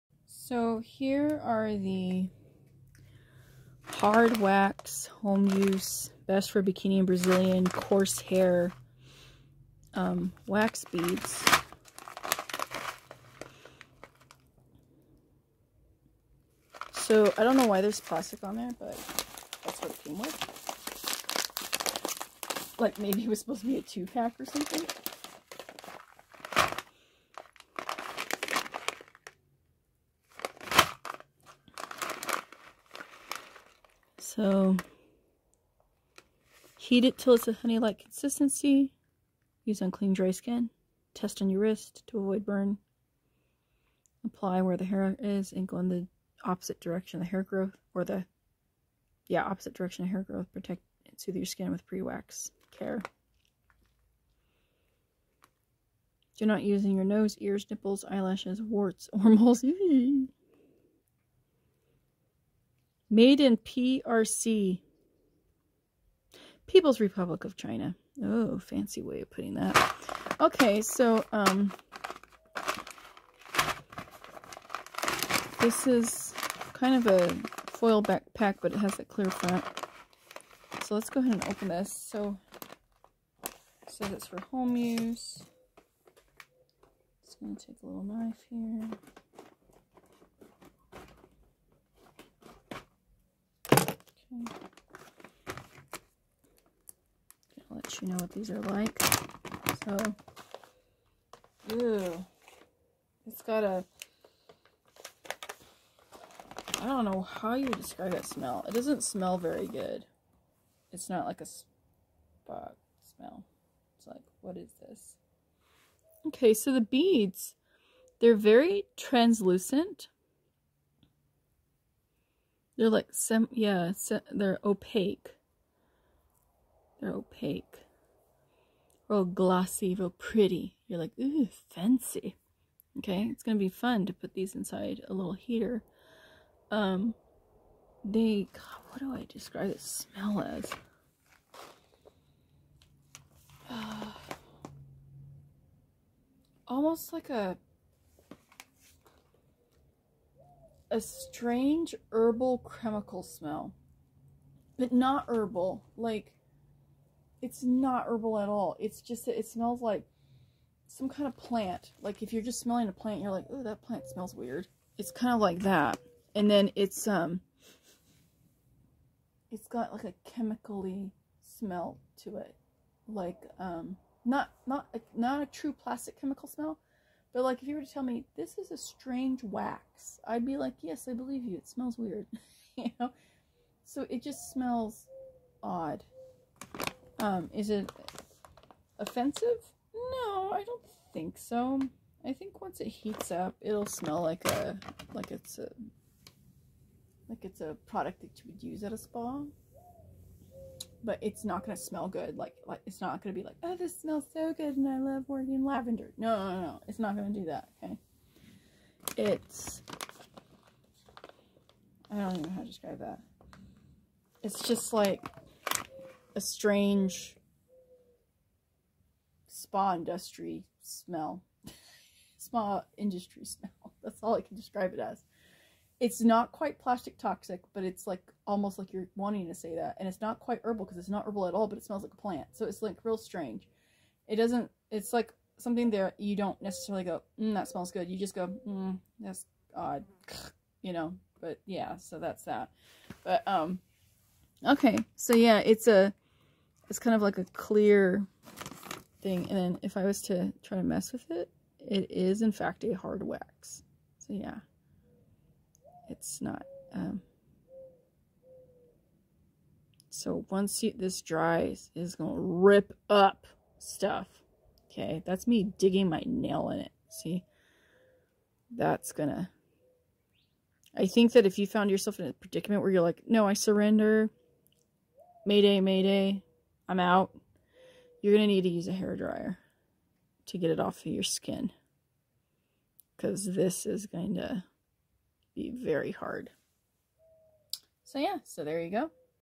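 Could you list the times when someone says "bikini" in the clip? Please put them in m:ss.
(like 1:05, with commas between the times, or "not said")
0:06.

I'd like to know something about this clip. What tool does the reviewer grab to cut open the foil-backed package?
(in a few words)
Knife.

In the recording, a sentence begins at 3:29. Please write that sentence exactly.
It's, I don't even know how to describe that.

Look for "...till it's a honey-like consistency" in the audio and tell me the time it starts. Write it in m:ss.
0:37.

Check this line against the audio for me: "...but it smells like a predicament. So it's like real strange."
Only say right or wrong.
wrong.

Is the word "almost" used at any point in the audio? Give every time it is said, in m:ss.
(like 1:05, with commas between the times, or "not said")
2:26, 3:48.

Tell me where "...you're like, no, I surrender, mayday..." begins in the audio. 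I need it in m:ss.
4:32.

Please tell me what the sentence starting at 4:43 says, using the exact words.
Because this is going to be very hard.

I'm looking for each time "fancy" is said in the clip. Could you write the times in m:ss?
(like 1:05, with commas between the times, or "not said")
1:08, 2:11.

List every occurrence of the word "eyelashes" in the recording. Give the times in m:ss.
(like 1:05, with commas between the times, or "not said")
0:58.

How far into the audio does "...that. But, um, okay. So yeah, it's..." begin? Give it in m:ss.
4:02.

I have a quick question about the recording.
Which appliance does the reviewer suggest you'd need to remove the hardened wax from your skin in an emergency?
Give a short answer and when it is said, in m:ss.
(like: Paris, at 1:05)
Hair dryer, at 4:38.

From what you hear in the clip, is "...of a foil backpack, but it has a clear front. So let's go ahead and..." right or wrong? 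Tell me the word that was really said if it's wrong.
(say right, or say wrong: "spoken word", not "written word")
right.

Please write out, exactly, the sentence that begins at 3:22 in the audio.
Like, like it's not going to be like, oh, this smells so good and I love working lavender.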